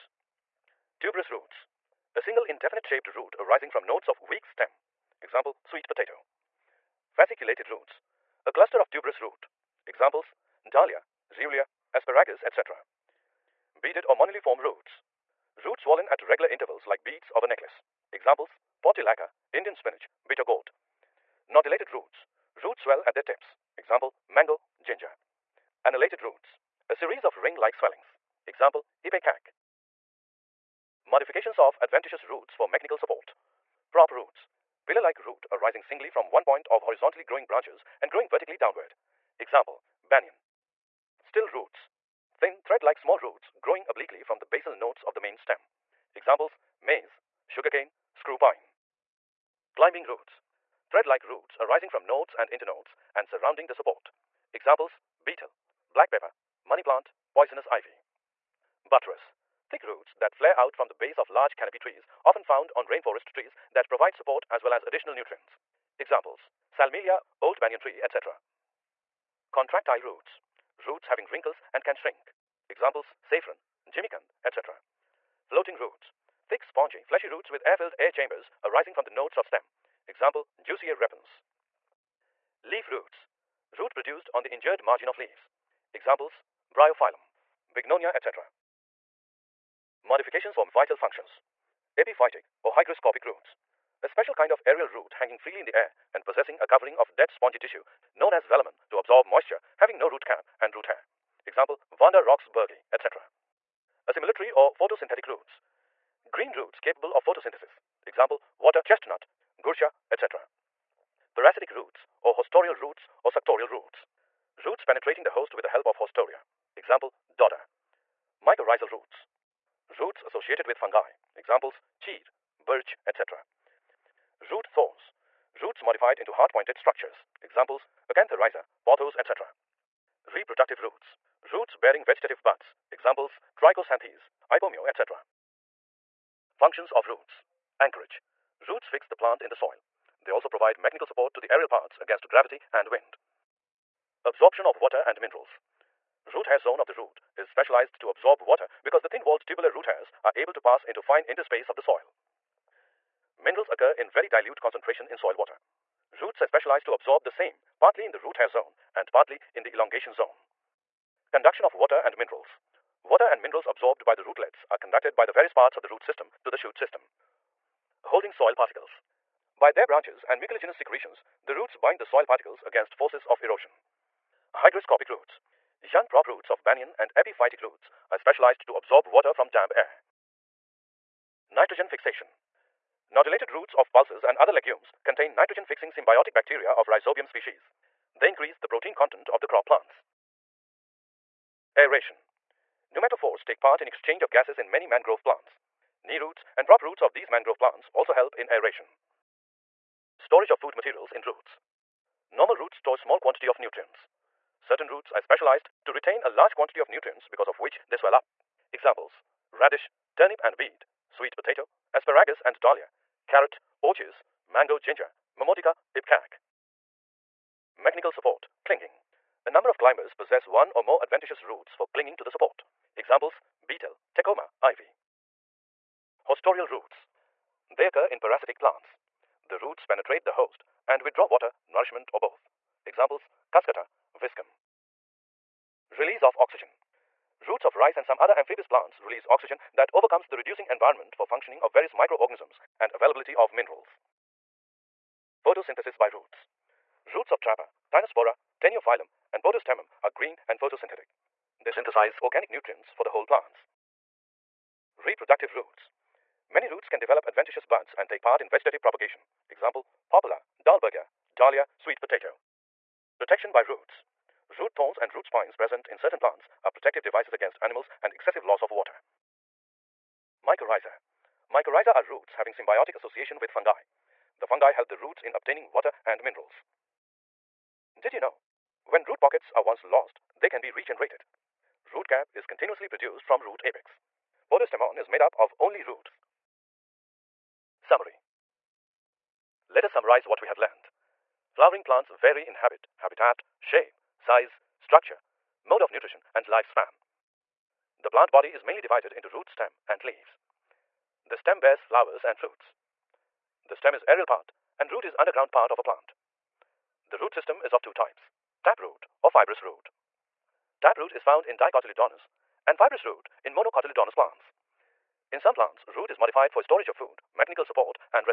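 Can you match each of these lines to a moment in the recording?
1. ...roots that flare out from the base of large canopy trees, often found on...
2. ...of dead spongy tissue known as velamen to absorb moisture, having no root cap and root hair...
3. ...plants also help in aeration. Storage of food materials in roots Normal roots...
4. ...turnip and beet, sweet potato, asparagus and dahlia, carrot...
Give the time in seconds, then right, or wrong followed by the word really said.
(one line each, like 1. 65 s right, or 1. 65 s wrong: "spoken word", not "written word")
1. 59 s right
2. 96 s right
3. 197 s right
4. 210 s right.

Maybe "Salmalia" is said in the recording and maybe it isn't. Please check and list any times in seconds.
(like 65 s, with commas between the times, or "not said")
66 s.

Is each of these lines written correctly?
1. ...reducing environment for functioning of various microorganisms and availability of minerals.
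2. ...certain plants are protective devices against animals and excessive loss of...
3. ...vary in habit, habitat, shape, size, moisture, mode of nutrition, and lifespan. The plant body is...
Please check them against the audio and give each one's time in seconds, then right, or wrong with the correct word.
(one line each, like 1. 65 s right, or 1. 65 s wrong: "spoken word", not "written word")
1. 240 s right
2. 265 s right
3. 292 s wrong: "structure", not "moisture".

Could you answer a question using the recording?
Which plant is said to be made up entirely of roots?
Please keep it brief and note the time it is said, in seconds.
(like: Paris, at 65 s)
Podostemon, at 284 s.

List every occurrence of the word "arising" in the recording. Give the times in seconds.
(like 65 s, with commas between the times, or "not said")
3 s, 35 s, 51 s, 78 s.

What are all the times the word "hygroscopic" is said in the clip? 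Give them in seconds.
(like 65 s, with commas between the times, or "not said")
92 s, 174 s.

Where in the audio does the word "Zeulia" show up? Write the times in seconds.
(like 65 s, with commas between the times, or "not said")
11 s.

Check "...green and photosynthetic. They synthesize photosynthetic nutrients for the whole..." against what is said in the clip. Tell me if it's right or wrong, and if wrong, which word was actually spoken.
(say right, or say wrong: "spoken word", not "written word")
wrong: "organic", not "photosynthetic".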